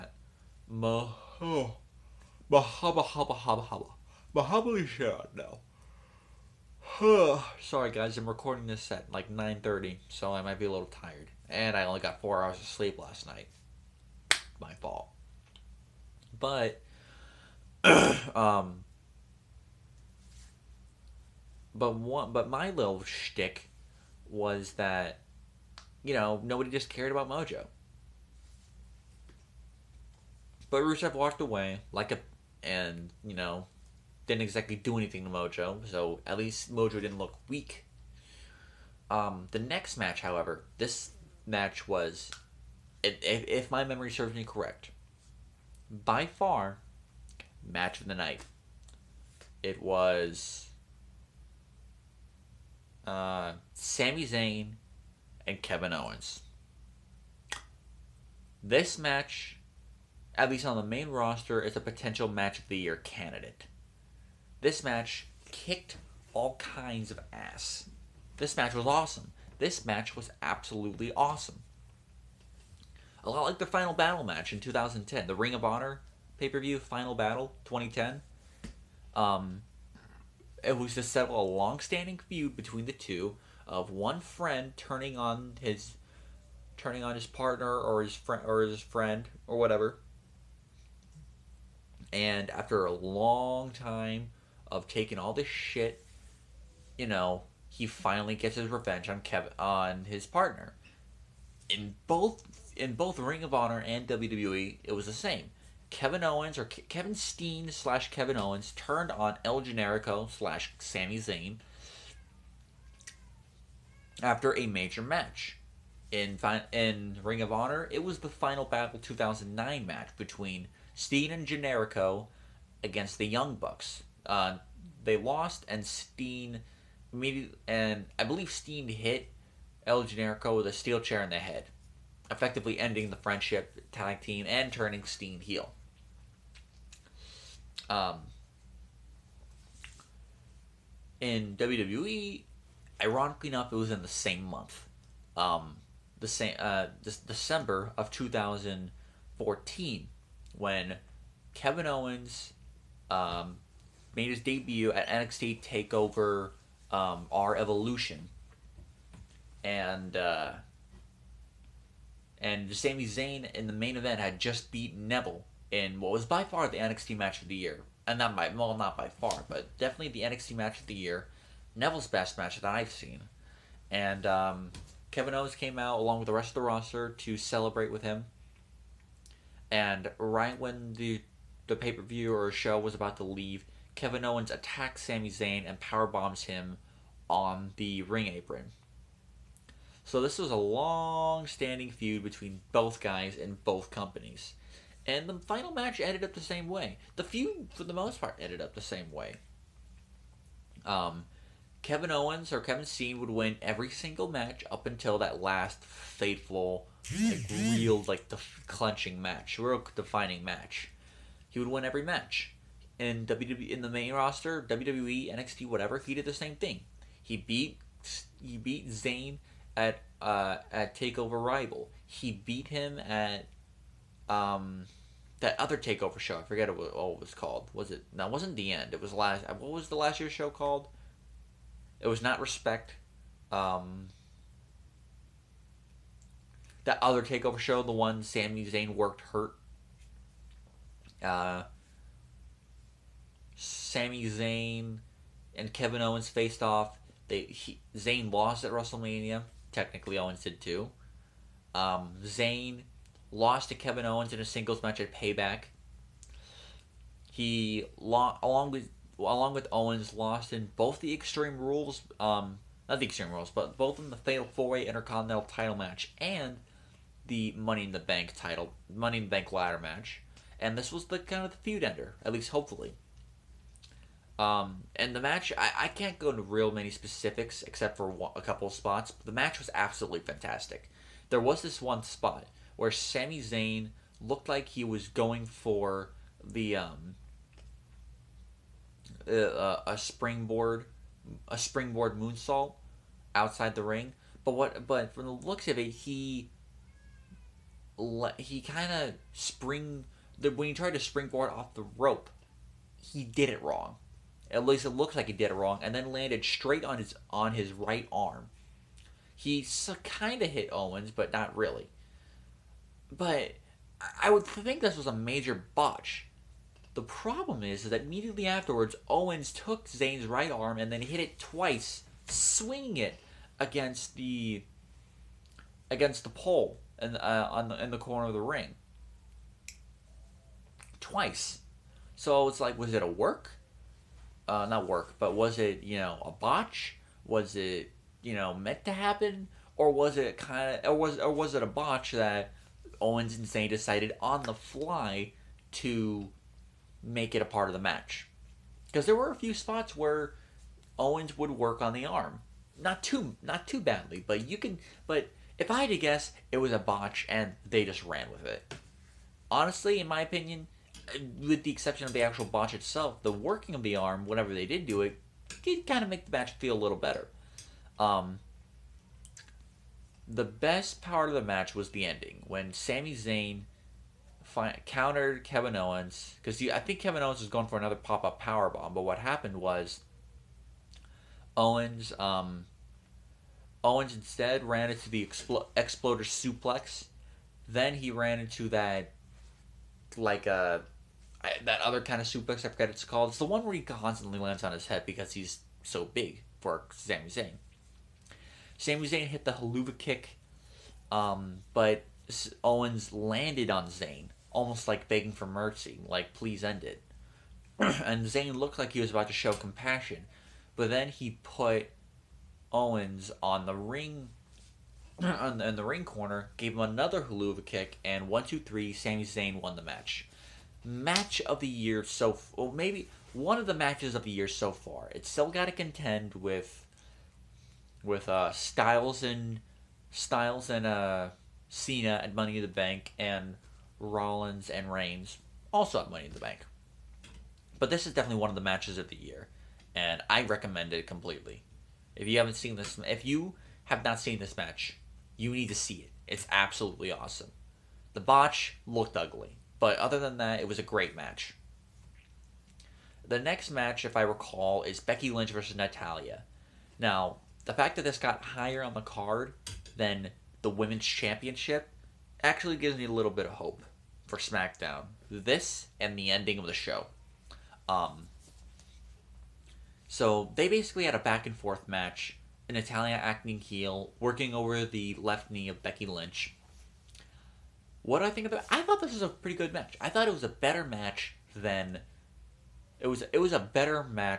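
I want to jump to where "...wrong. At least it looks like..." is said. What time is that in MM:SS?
05:03.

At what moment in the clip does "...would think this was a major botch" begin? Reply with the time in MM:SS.
05:14.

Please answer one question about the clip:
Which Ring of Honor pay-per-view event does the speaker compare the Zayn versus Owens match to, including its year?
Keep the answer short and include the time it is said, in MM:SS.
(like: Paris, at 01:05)
Final Battle 2010, at 01:16.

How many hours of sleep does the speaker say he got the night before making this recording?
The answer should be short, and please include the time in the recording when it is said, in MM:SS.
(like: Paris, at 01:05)
4, at 00:12.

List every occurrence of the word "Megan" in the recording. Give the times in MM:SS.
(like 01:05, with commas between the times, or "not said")
not said.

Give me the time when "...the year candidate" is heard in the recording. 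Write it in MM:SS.
01:02.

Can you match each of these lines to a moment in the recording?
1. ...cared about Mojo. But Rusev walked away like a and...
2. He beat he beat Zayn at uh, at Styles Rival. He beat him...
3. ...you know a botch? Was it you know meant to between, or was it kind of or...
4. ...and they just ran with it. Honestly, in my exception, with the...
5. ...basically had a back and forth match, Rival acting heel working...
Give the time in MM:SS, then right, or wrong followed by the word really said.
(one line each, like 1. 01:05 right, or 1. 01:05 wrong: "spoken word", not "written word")
1. 00:26 right
2. 03:37 wrong: "Takeover", not "Styles"
3. 05:35 wrong: "happen", not "between"
4. 05:57 wrong: "opinion", not "exception"
5. 07:50 wrong: "Natalya", not "Rival".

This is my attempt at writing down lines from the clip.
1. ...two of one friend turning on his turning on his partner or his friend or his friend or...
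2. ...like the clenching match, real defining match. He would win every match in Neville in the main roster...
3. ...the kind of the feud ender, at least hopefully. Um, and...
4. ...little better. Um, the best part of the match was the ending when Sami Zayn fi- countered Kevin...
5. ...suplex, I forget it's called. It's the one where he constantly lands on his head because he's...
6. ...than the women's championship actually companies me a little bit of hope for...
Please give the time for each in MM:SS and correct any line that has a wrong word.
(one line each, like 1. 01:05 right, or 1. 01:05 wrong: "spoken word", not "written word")
1. 01:22 right
2. 03:28 wrong: "WWE", not "Neville"
3. 04:31 right
4. 06:06 right
5. 06:32 right
6. 07:39 wrong: "gives", not "companies".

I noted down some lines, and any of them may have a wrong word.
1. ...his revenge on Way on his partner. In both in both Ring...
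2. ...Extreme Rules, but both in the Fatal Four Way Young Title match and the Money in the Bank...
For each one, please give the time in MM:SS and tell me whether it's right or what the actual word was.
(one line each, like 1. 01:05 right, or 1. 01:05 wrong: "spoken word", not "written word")
1. 01:38 wrong: "Kevin", not "Way"
2. 04:23 wrong: "Intercontinental", not "Young".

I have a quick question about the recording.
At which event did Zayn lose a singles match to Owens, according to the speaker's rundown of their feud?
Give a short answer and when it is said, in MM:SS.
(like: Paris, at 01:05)
Payback, at 04:15.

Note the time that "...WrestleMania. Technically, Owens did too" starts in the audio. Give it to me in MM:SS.
04:08.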